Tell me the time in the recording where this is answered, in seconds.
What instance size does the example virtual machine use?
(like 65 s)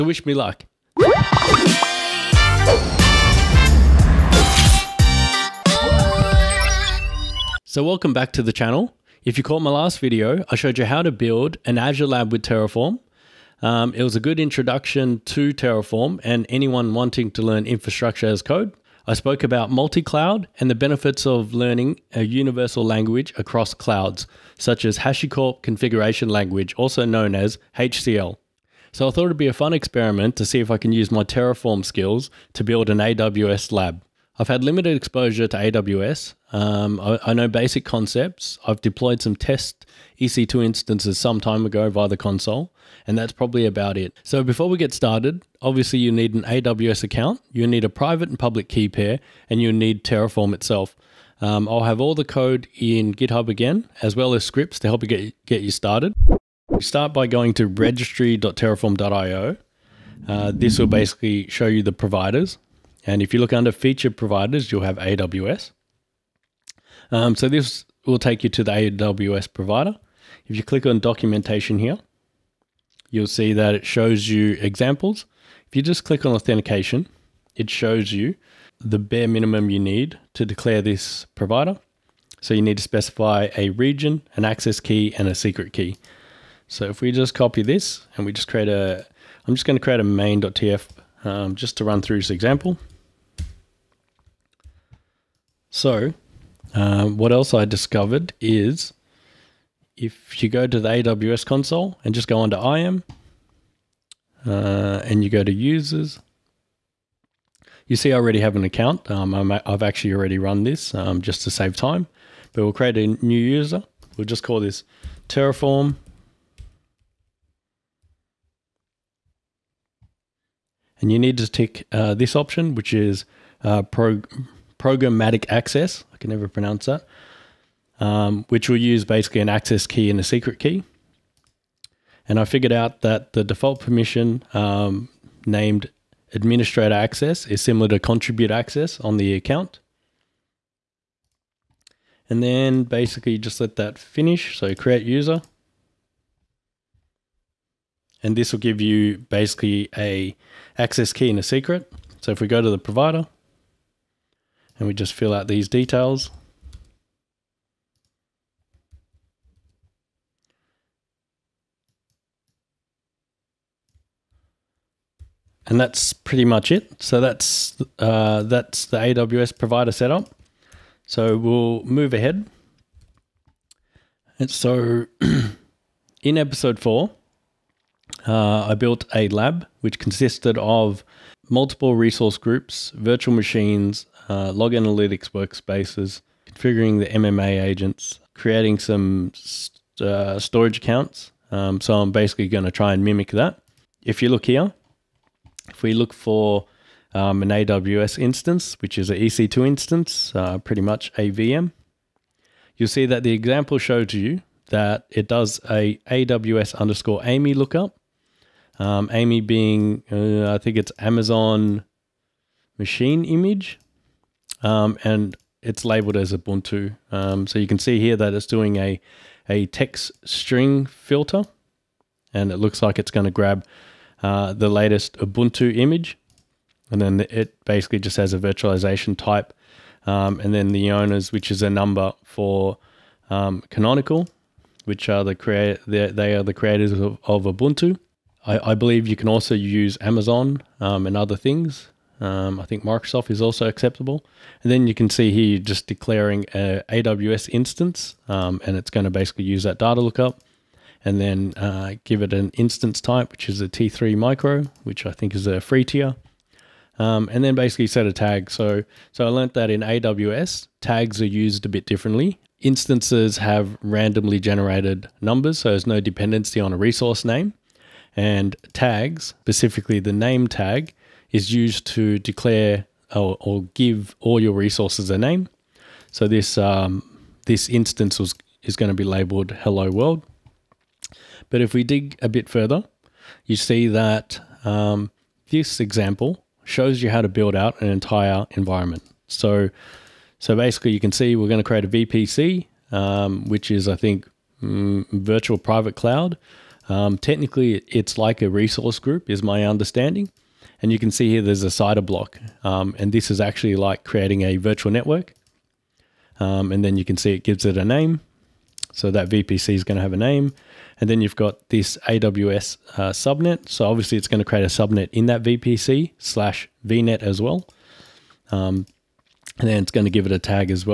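253 s.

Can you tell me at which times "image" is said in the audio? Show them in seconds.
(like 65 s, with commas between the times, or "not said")
213 s, 225 s.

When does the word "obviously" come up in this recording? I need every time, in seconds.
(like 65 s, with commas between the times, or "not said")
45 s, 313 s.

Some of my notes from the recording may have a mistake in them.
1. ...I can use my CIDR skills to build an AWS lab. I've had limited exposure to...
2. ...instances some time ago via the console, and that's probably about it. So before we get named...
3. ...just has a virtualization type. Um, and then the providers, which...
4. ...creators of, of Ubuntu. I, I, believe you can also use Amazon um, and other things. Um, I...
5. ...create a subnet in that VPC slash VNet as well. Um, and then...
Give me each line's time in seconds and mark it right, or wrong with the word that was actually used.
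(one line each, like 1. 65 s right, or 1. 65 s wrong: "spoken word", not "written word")
1. 30 s wrong: "Terraform", not "CIDR"
2. 40 s wrong: "started", not "named"
3. 227 s wrong: "owners", not "providers"
4. 236 s right
5. 314 s right.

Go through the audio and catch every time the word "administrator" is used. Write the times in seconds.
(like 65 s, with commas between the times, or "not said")
136 s.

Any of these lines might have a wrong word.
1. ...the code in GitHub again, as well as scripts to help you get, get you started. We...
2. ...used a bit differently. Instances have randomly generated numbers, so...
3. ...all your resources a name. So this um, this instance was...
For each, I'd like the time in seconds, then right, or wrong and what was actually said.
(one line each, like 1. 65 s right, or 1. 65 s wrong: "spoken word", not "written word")
1. 52 s right
2. 261 s right
3. 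274 s right.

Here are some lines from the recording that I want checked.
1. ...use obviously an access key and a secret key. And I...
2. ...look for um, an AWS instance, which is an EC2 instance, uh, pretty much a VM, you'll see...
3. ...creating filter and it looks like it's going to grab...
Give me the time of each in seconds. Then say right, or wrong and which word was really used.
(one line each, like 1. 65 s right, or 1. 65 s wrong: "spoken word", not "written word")
1. 128 s wrong: "basically", not "obviously"
2. 195 s right
3. 220 s wrong: "string", not "creating".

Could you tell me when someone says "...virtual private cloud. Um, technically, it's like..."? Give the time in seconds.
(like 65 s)
295 s.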